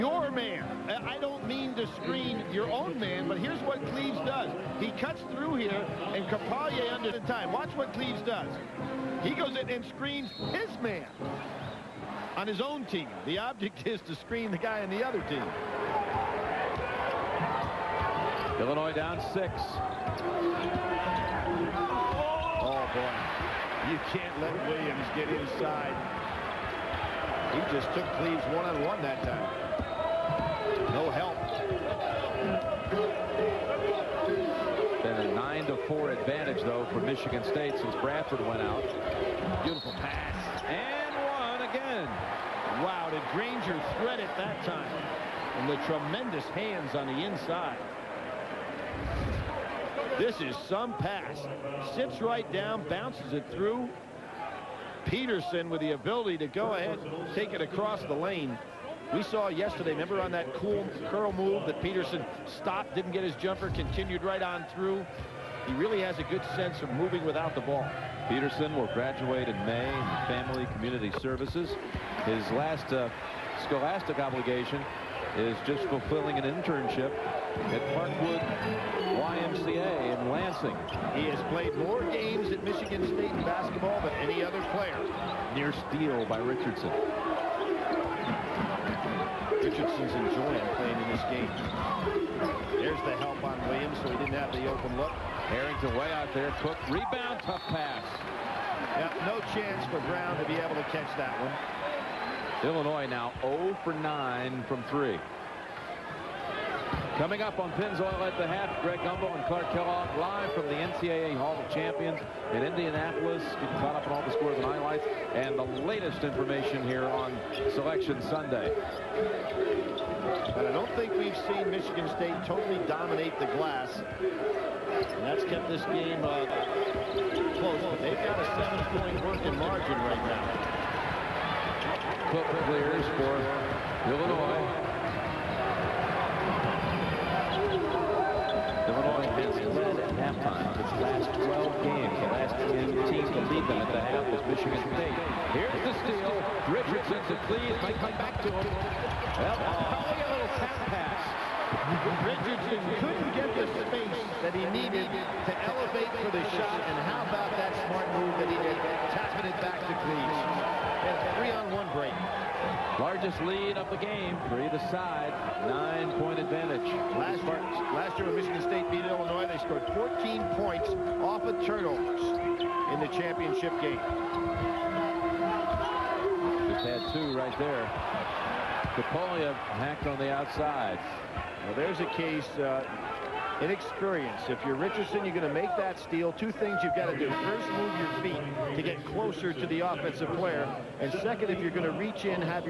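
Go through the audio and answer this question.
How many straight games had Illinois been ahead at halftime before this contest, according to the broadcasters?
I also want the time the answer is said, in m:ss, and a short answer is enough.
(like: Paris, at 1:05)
12, at 2:21.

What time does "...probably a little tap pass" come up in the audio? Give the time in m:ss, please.
2:29.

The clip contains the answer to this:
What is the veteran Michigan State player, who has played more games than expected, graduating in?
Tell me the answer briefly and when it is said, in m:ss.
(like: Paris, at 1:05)
Family Community Services, at 1:10.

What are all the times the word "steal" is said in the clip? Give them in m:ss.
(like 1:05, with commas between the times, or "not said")
1:25, 2:26, 3:05.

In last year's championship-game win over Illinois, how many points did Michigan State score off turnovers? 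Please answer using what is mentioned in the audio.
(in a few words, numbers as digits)
14.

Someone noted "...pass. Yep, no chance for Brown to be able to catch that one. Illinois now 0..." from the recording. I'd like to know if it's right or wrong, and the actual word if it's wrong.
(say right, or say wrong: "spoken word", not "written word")
right.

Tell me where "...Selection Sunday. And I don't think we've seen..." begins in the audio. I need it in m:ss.
1:57.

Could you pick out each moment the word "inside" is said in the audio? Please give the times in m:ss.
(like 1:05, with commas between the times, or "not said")
0:25, 0:47.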